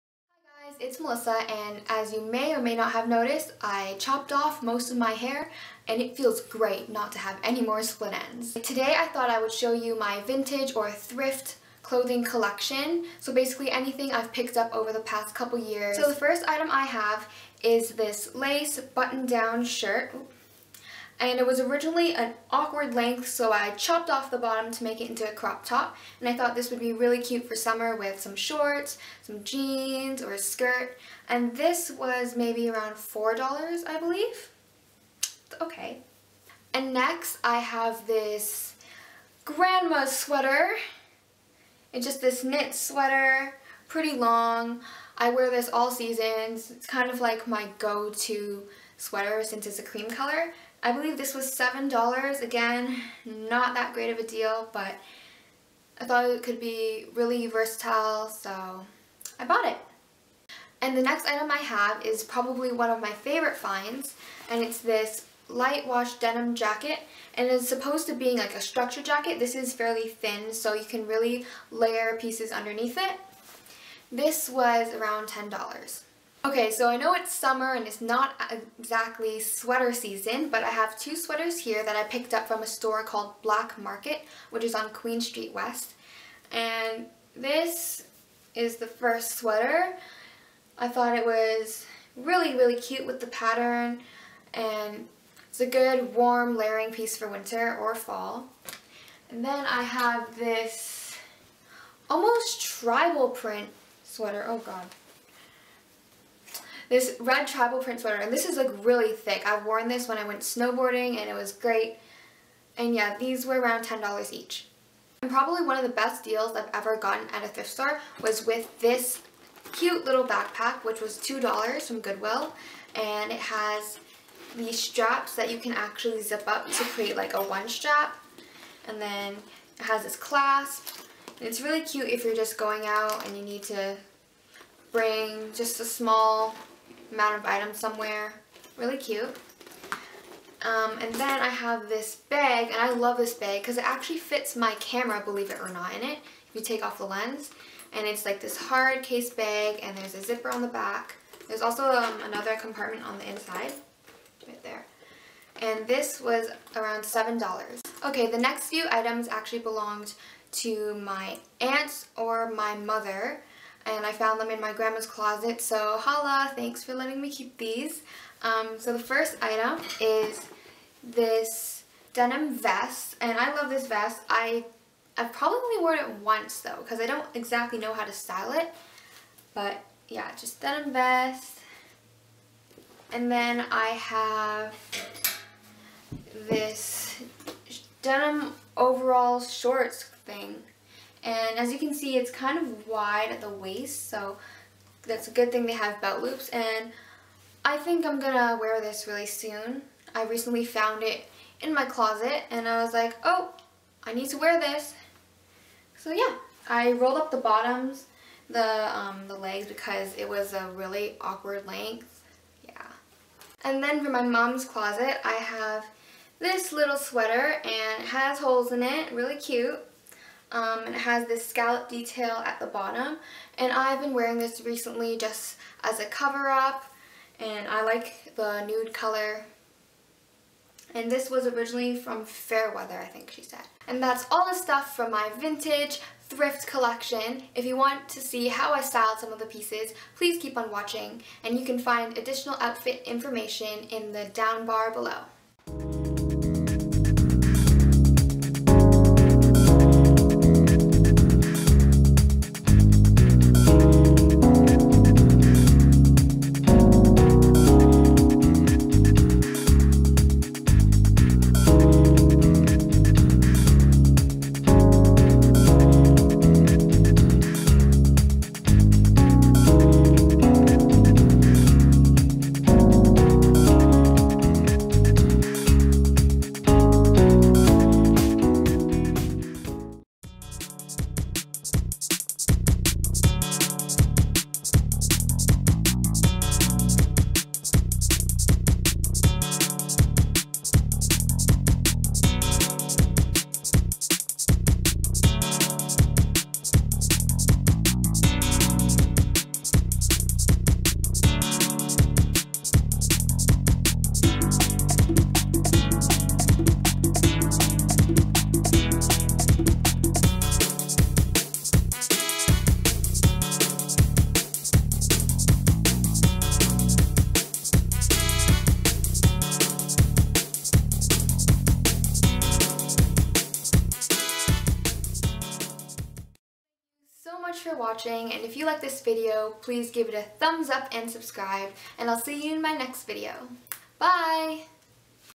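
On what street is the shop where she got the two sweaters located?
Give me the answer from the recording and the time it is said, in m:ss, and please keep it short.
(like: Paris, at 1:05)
Queen Street West, at 1:24.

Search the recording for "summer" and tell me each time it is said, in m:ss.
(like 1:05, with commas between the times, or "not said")
0:27, 1:17.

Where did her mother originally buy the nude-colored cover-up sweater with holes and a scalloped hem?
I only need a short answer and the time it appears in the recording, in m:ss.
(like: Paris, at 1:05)
Fairweather, at 3:52.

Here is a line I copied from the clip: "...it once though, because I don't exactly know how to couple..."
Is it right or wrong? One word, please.
wrong.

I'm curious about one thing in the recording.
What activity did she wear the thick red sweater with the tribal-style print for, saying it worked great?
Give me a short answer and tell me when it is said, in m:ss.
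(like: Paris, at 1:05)
Snowboarding, at 1:50.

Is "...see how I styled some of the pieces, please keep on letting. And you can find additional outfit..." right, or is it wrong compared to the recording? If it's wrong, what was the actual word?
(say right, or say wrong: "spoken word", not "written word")
wrong: "watching", not "letting".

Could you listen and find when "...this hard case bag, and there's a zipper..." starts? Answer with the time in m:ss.
2:28.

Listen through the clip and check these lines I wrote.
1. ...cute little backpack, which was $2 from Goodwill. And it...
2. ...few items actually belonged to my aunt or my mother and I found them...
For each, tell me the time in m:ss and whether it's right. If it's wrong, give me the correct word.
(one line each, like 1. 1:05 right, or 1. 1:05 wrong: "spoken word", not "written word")
1. 1:59 right
2. 2:38 right.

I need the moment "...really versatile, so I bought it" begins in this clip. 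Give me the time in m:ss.
0:57.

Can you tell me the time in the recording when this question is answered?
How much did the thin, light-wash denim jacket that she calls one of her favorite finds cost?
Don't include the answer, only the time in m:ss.
1:15.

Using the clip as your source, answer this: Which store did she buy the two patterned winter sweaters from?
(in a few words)
Black Market.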